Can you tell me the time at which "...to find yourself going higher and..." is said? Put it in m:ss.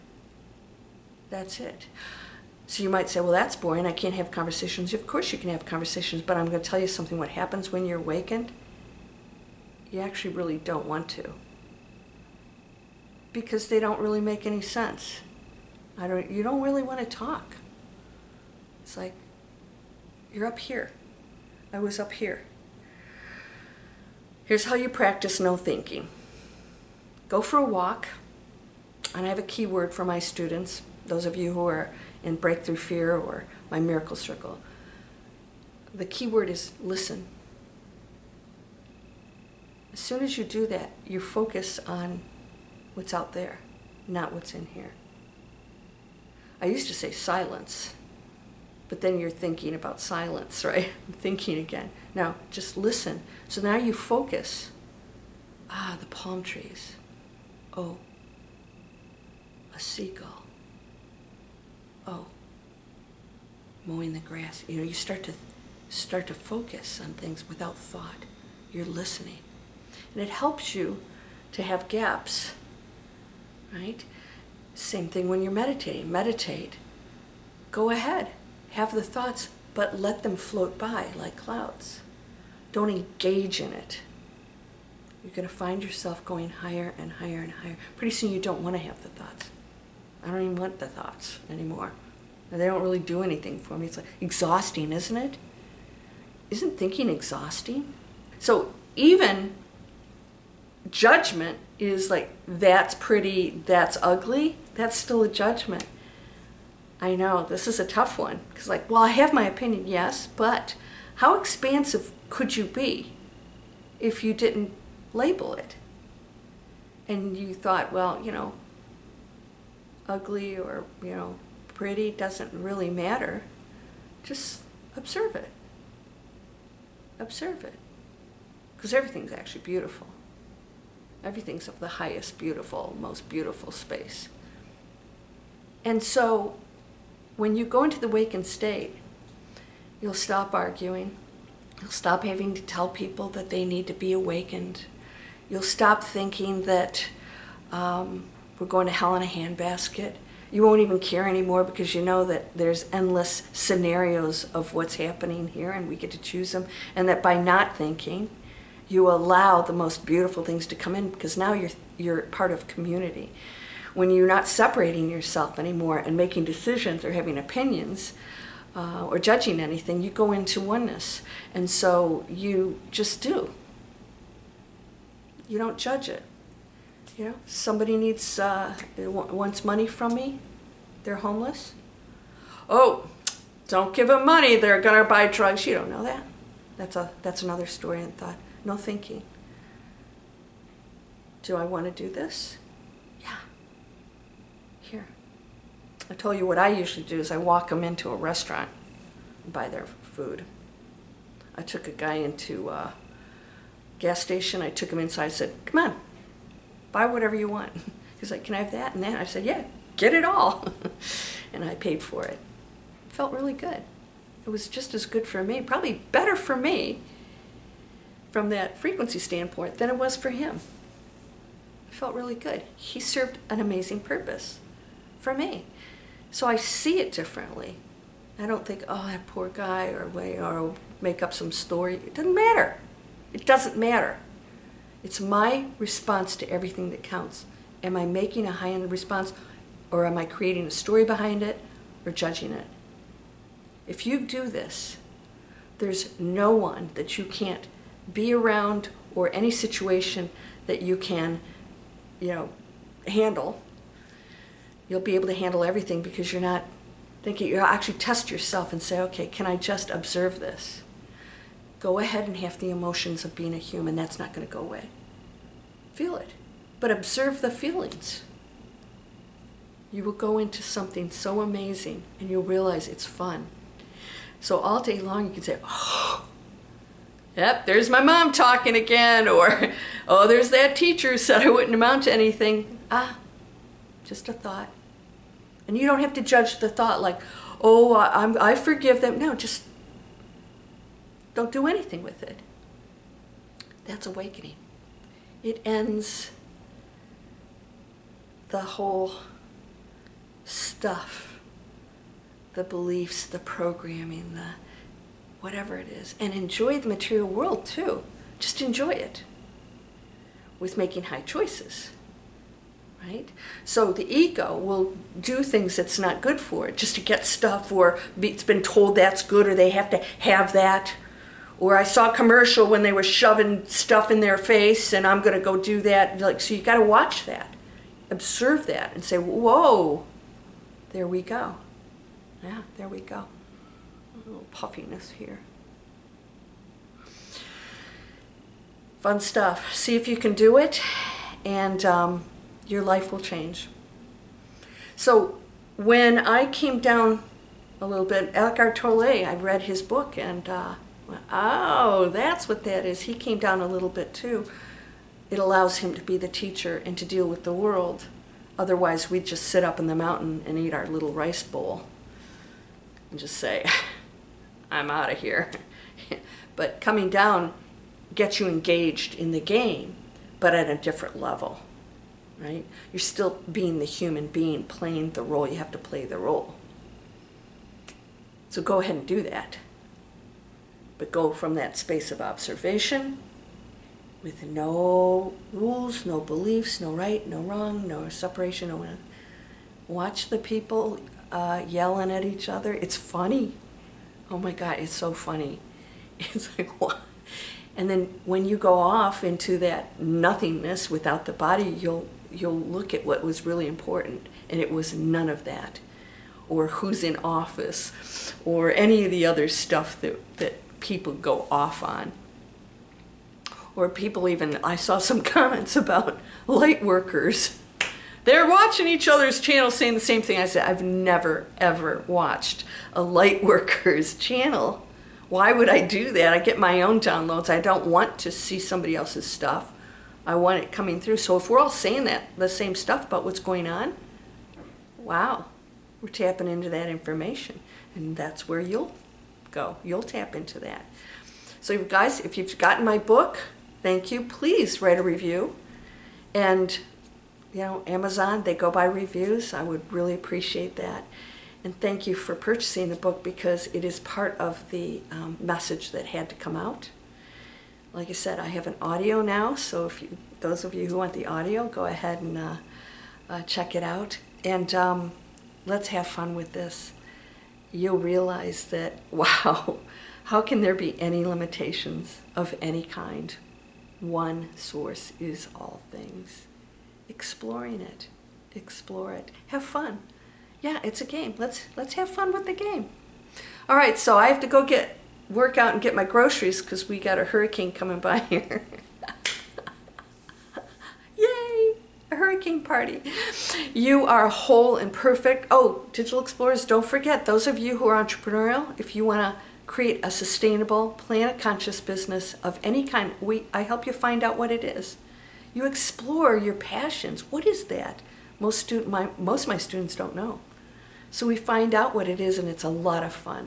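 1:25.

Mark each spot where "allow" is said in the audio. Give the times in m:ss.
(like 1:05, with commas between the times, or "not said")
2:39, 5:55.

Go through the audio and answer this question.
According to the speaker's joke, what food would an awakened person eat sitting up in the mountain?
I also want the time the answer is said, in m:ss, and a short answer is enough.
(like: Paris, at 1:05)
rice bowl, at 6:00.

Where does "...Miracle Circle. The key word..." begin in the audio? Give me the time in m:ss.
0:33.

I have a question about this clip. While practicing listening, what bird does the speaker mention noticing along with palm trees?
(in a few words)
a seagull.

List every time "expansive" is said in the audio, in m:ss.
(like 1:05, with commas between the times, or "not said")
1:51.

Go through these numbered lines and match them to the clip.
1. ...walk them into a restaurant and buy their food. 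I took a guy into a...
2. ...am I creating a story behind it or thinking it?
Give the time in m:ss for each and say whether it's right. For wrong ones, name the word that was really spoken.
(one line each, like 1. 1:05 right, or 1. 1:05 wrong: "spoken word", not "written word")
1. 3:17 right
2. 4:00 wrong: "judging", not "thinking".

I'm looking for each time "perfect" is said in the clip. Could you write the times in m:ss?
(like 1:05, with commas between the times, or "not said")
8:14.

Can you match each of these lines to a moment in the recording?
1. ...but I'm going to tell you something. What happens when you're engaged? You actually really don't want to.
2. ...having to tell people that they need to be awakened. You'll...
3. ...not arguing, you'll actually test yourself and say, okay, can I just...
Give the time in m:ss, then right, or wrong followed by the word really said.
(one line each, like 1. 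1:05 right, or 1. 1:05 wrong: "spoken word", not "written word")
1. 0:06 wrong: "awakened", not "engaged"
2. 2:22 right
3. 4:16 wrong: "thinking", not "arguing".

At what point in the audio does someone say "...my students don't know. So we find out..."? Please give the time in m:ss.
8:29.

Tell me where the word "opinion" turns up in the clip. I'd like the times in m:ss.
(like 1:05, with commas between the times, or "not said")
1:49, 2:47.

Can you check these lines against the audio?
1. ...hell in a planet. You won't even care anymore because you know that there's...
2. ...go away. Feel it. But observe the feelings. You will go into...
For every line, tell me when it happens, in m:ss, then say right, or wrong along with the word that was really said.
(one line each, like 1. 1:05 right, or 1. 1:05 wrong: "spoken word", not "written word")
1. 2:28 wrong: "handbasket", not "planet"
2. 4:24 right.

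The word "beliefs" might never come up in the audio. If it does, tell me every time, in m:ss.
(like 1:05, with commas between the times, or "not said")
5:02, 6:26.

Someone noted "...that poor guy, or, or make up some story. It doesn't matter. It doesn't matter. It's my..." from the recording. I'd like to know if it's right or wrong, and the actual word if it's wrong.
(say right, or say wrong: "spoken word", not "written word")
right.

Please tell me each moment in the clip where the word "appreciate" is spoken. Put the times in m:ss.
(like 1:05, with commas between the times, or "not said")
7:30.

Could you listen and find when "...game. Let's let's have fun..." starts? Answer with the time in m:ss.
8:01.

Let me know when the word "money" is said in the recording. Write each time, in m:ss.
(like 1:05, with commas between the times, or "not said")
2:59, 3:04.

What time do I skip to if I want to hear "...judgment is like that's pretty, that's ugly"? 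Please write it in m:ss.
1:40.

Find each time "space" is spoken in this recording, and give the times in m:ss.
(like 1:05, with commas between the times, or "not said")
2:13, 6:21.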